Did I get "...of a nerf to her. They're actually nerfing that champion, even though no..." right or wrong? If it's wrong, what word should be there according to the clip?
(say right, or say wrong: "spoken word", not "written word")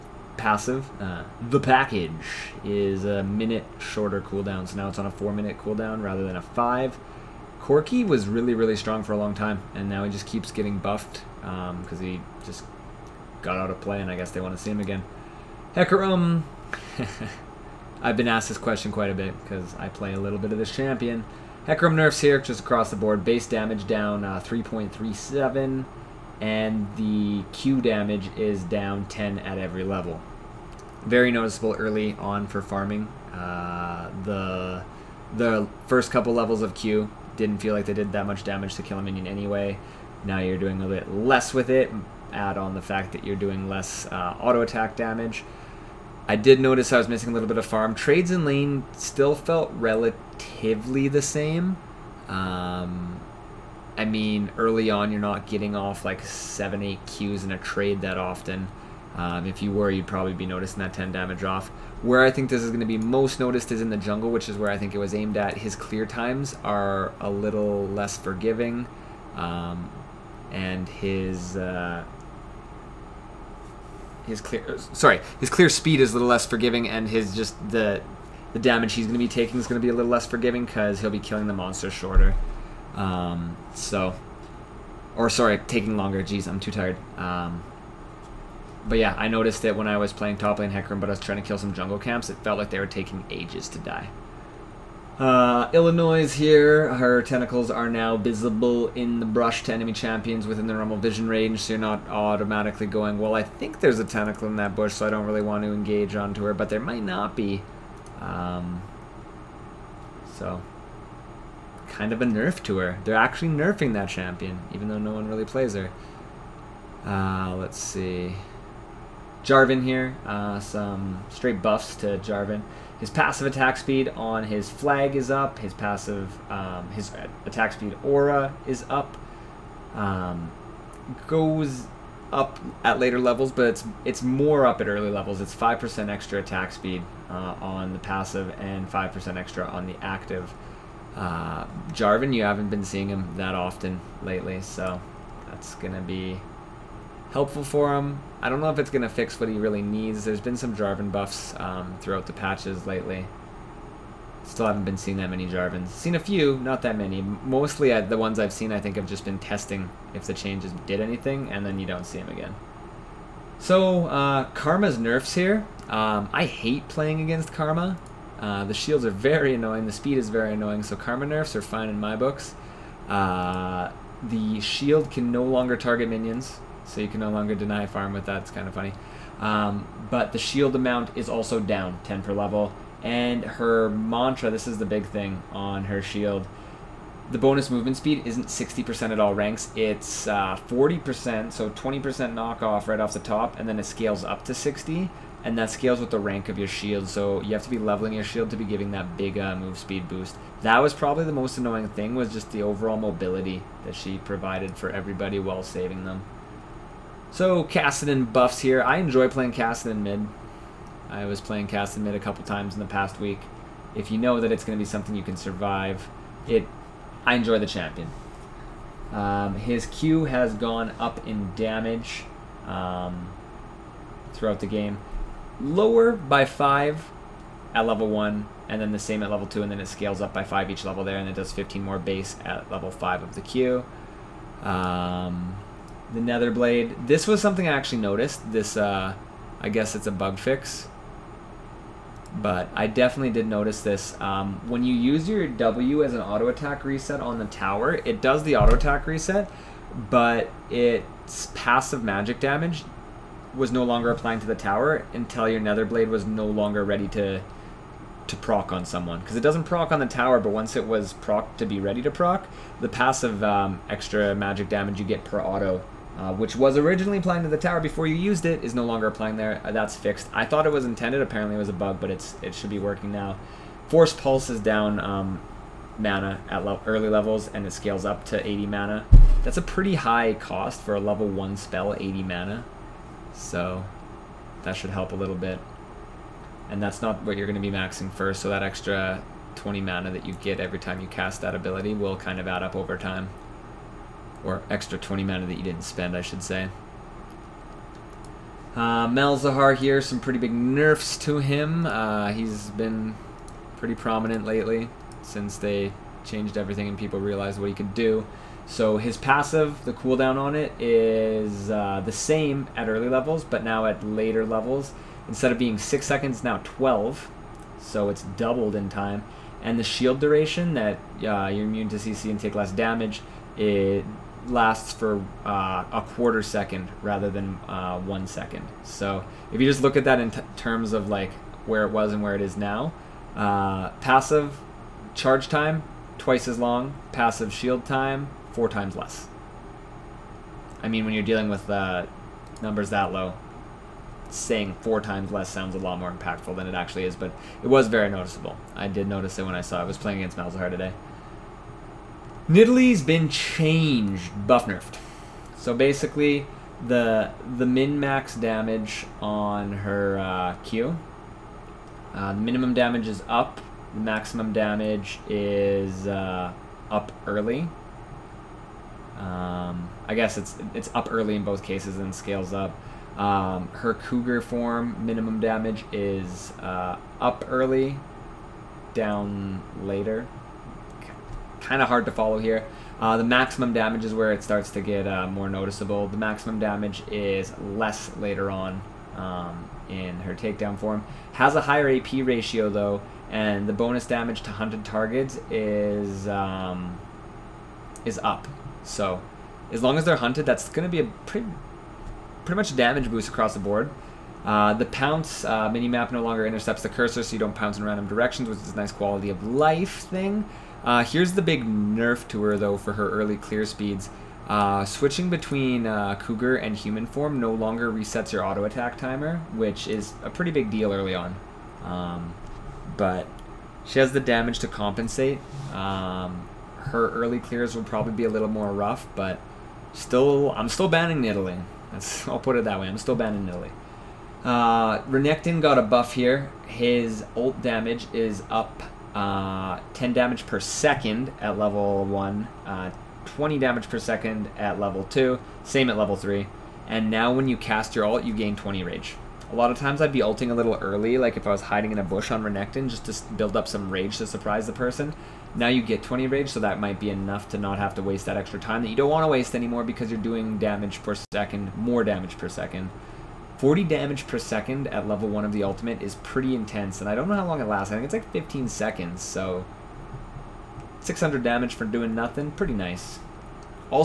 right.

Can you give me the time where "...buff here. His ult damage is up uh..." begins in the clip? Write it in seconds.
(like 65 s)
435 s.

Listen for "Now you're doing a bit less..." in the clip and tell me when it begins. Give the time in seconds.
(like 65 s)
40 s.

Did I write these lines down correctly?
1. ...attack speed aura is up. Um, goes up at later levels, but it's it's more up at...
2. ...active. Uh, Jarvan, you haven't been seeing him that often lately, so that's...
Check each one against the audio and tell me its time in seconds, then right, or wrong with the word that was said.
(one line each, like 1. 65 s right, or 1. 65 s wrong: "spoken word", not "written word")
1. 127 s right
2. 140 s right.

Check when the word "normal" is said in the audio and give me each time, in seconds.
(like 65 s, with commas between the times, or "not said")
100 s.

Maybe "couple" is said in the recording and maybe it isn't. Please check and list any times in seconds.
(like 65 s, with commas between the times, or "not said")
36 s, 212 s.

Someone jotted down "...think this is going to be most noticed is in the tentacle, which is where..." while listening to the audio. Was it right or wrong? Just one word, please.
wrong.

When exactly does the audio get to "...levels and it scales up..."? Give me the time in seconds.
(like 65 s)
277 s.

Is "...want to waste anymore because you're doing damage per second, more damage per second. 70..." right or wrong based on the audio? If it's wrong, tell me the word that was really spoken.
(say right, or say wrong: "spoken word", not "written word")
wrong: "40", not "70".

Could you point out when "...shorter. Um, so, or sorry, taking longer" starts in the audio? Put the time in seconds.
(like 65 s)
81 s.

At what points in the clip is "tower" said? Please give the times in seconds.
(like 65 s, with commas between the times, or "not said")
247 s, 254 s, 260 s, 267 s.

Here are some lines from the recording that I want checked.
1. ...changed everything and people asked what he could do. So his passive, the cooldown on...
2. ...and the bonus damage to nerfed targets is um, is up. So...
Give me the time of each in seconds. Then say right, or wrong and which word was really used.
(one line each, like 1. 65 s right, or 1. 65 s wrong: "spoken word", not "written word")
1. 306 s wrong: "realized", not "asked"
2. 393 s wrong: "hunted", not "nerfed".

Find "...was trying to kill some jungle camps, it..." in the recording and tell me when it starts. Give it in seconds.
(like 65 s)
91 s.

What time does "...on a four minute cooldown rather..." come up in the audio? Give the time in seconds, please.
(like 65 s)
4 s.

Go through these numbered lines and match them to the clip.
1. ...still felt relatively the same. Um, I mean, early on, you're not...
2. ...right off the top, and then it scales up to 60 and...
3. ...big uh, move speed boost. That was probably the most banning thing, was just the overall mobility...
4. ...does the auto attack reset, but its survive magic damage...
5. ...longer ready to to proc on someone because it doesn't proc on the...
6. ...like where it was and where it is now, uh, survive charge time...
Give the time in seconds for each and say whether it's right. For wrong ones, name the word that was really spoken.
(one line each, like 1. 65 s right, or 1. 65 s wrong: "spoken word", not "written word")
1. 48 s right
2. 192 s right
3. 199 s wrong: "annoying", not "banning"
4. 248 s wrong: "passive", not "survive"
5. 256 s right
6. 331 s wrong: "passive", not "survive".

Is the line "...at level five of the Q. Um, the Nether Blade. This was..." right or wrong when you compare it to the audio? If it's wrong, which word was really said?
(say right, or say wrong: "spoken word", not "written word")
right.